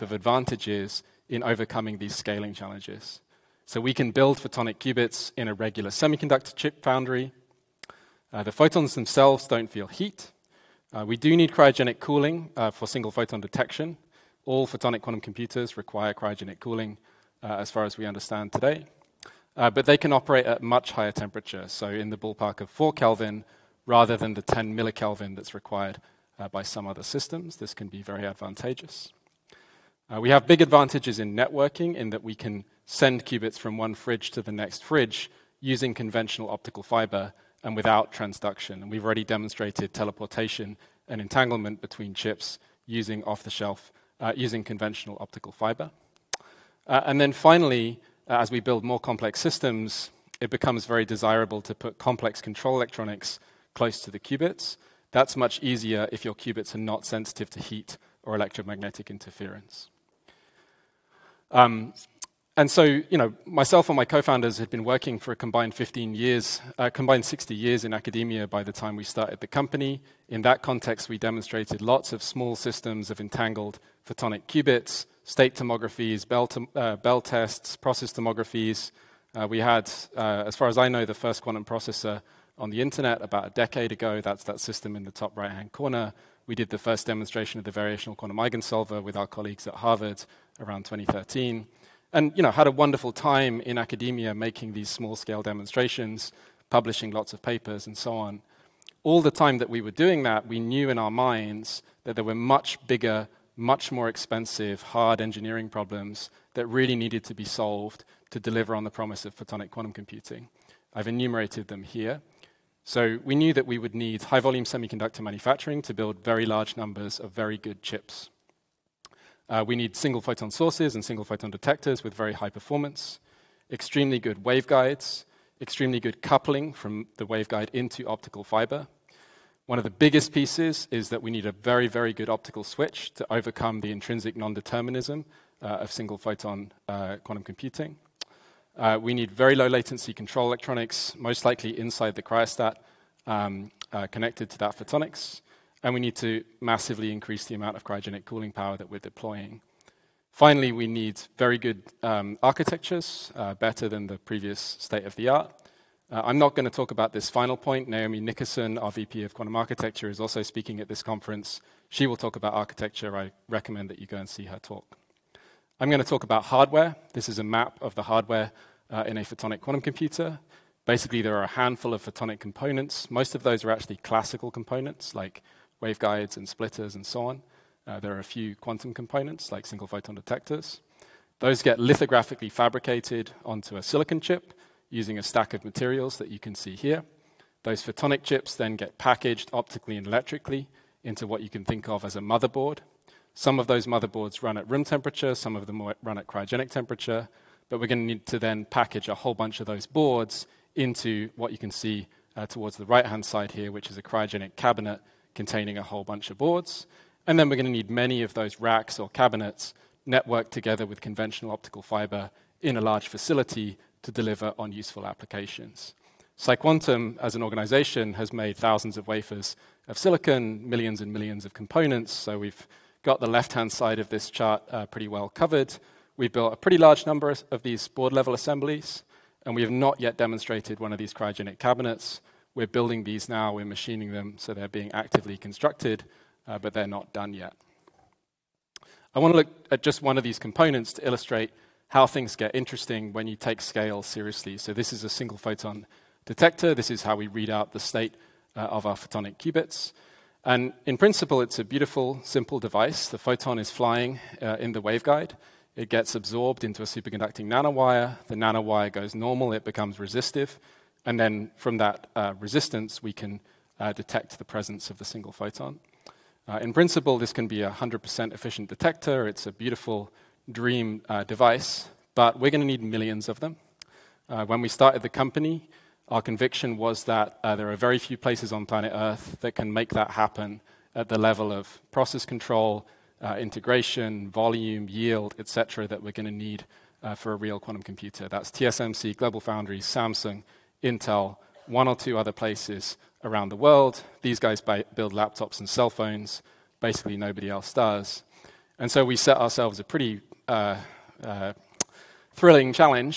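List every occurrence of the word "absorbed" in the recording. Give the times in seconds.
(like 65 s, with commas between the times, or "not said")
256 s.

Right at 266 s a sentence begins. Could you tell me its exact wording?
Uh, in principle, this can be a 100% efficient detector.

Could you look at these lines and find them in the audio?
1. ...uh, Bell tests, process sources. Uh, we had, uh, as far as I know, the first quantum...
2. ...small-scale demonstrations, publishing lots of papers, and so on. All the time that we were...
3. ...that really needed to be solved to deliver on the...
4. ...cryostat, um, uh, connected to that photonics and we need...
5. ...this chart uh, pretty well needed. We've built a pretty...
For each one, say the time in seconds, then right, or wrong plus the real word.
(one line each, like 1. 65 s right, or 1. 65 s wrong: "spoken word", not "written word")
1. 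76 s wrong: "tomographies", not "sources"
2. 94 s right
3. 106 s right
4. 142 s right
5. 224 s wrong: "covered", not "needed".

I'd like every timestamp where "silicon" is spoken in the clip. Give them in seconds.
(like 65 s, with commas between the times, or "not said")
183 s, 219 s.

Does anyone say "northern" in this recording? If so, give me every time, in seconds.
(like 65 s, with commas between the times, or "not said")
not said.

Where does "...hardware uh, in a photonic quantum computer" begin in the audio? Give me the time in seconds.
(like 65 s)
168 s.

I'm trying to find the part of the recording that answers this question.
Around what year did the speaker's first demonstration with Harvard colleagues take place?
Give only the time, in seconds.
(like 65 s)
90 s.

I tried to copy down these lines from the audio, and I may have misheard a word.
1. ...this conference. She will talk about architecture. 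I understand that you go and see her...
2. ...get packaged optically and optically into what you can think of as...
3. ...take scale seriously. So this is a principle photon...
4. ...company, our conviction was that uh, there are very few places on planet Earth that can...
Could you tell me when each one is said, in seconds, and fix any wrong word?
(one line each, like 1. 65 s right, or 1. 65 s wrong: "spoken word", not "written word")
1. 160 s wrong: "recommend", not "understand"
2. 188 s wrong: "electrically", not "optically"
3. 243 s wrong: "single", not "principle"
4. 275 s right.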